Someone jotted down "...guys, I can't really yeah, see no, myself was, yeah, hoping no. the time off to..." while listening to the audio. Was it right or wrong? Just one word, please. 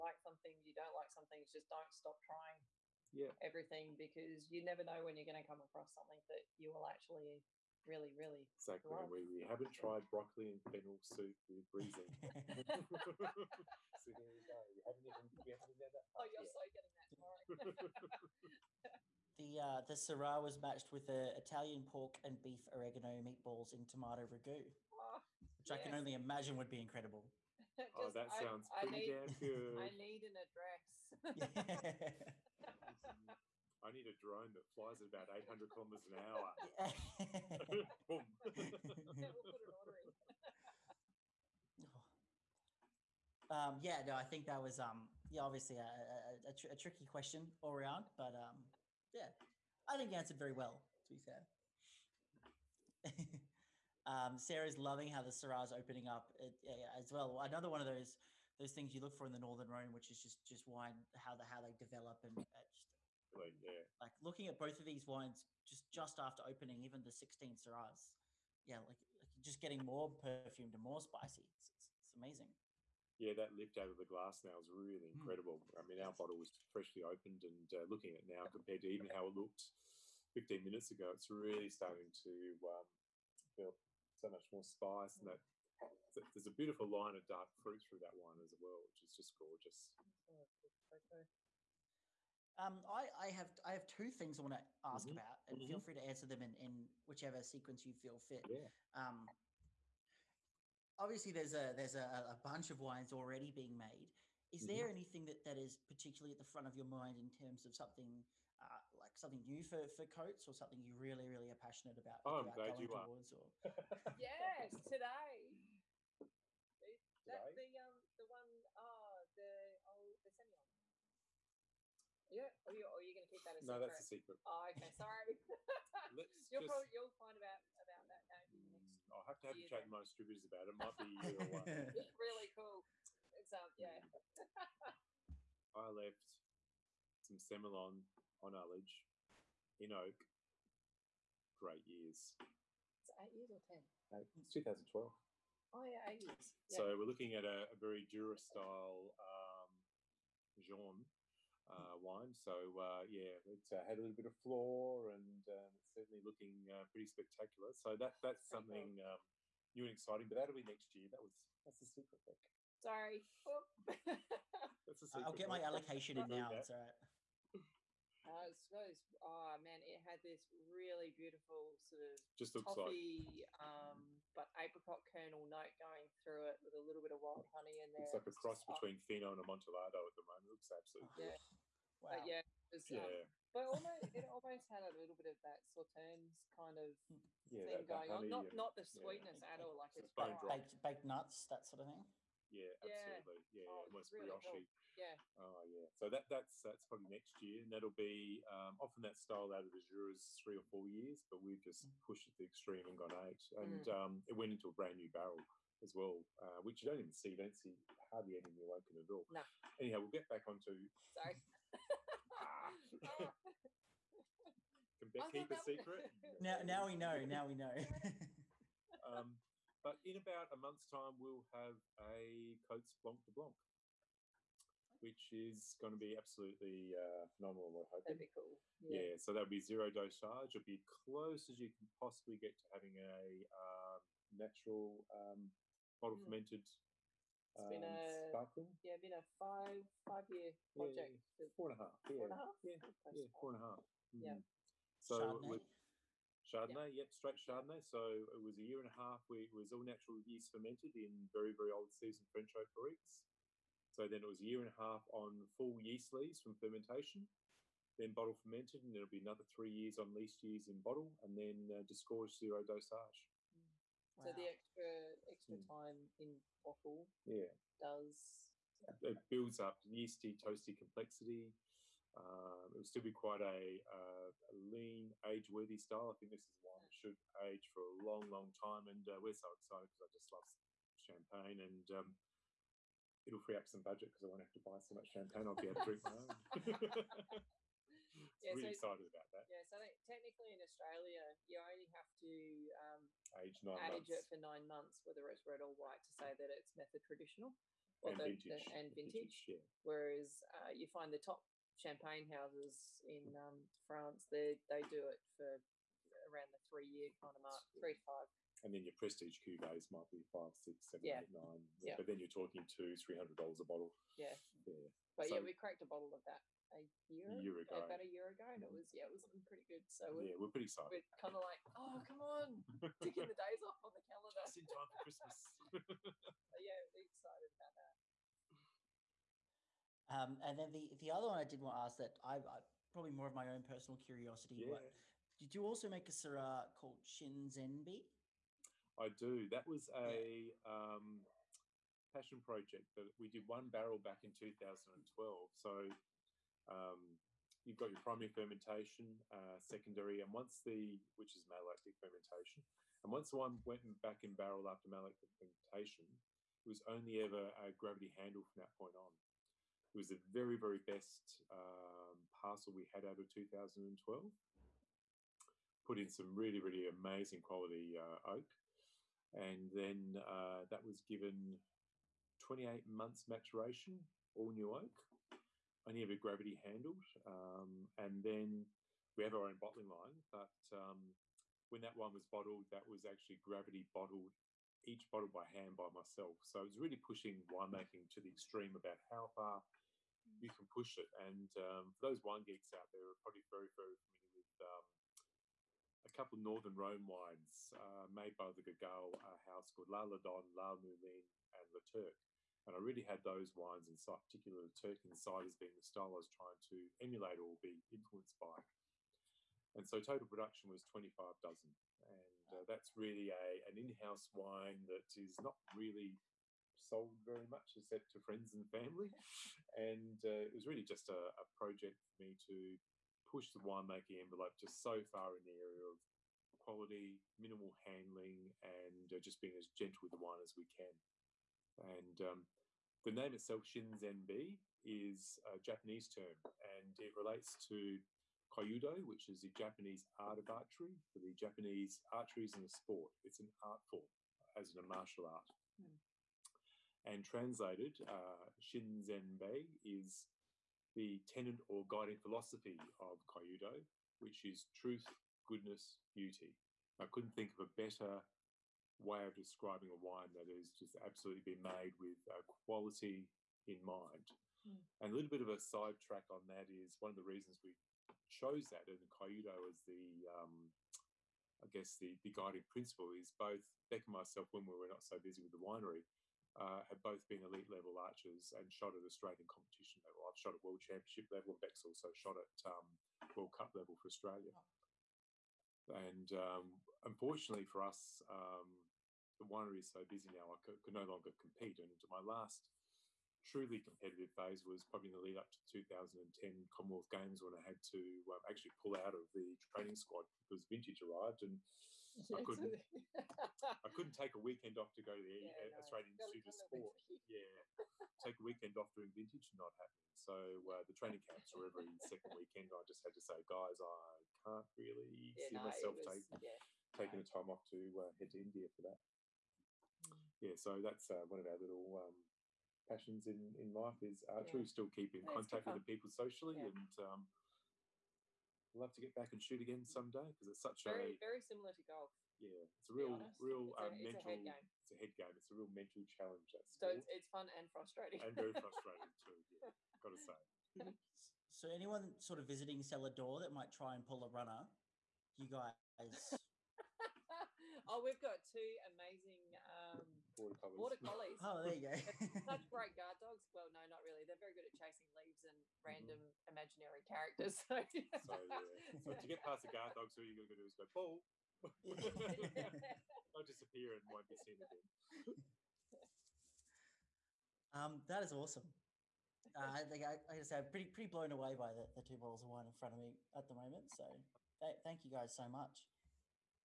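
wrong.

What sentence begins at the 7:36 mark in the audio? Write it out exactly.
I couldn't think of a better way of describing a wine that is just absolutely been made with uh, quality in mind.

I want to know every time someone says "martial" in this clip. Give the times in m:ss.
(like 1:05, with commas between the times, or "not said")
7:24.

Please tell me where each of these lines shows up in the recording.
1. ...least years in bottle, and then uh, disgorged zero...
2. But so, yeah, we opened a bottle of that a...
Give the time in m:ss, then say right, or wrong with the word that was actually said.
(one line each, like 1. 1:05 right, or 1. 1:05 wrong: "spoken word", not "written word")
1. 4:20 right
2. 5:15 wrong: "cracked", not "opened".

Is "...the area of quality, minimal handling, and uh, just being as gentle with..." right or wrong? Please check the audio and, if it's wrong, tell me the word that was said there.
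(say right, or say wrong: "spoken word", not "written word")
right.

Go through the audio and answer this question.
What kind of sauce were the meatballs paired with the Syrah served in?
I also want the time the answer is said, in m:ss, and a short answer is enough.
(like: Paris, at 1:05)
Tomato ragu, at 0:23.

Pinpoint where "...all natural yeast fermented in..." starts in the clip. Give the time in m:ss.
4:09.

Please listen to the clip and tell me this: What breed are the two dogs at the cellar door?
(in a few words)
Border collies.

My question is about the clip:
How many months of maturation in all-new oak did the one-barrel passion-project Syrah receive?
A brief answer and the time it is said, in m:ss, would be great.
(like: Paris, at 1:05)
28, at 6:12.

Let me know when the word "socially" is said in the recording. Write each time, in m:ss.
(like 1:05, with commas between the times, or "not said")
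8:46.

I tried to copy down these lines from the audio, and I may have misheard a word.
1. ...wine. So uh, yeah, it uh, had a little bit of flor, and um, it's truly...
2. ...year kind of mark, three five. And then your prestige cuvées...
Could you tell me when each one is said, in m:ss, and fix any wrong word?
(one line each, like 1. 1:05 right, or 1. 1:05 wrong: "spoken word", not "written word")
1. 2:31 wrong: "certainly", not "truly"
2. 5:06 right.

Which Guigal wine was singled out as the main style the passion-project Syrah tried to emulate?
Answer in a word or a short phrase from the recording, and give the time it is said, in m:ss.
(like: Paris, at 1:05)
La Turque, at 6:44.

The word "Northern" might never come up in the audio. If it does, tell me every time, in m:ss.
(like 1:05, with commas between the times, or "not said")
0:59, 6:36.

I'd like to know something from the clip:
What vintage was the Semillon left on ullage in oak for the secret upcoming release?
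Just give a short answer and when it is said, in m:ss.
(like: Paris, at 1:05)
2012, at 2:24.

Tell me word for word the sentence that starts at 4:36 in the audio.
I think this is one that should age for a long, long time.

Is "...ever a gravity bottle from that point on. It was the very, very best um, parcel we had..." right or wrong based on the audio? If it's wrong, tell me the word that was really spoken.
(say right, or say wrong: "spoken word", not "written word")
wrong: "handle", not "bottle".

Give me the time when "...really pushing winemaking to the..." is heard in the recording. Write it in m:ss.
6:26.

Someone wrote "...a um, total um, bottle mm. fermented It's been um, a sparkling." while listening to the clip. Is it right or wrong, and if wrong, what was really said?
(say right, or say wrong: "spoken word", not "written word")
wrong: "natural", not "total".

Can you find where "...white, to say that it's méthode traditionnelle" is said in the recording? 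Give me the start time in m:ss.
4:55.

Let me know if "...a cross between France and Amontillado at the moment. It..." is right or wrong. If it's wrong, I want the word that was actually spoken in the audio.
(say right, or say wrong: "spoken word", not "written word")
wrong: "Fino", not "France".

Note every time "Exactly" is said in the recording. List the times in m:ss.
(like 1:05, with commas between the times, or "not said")
0:08, 1:03.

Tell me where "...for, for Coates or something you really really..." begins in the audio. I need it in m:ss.
1:49.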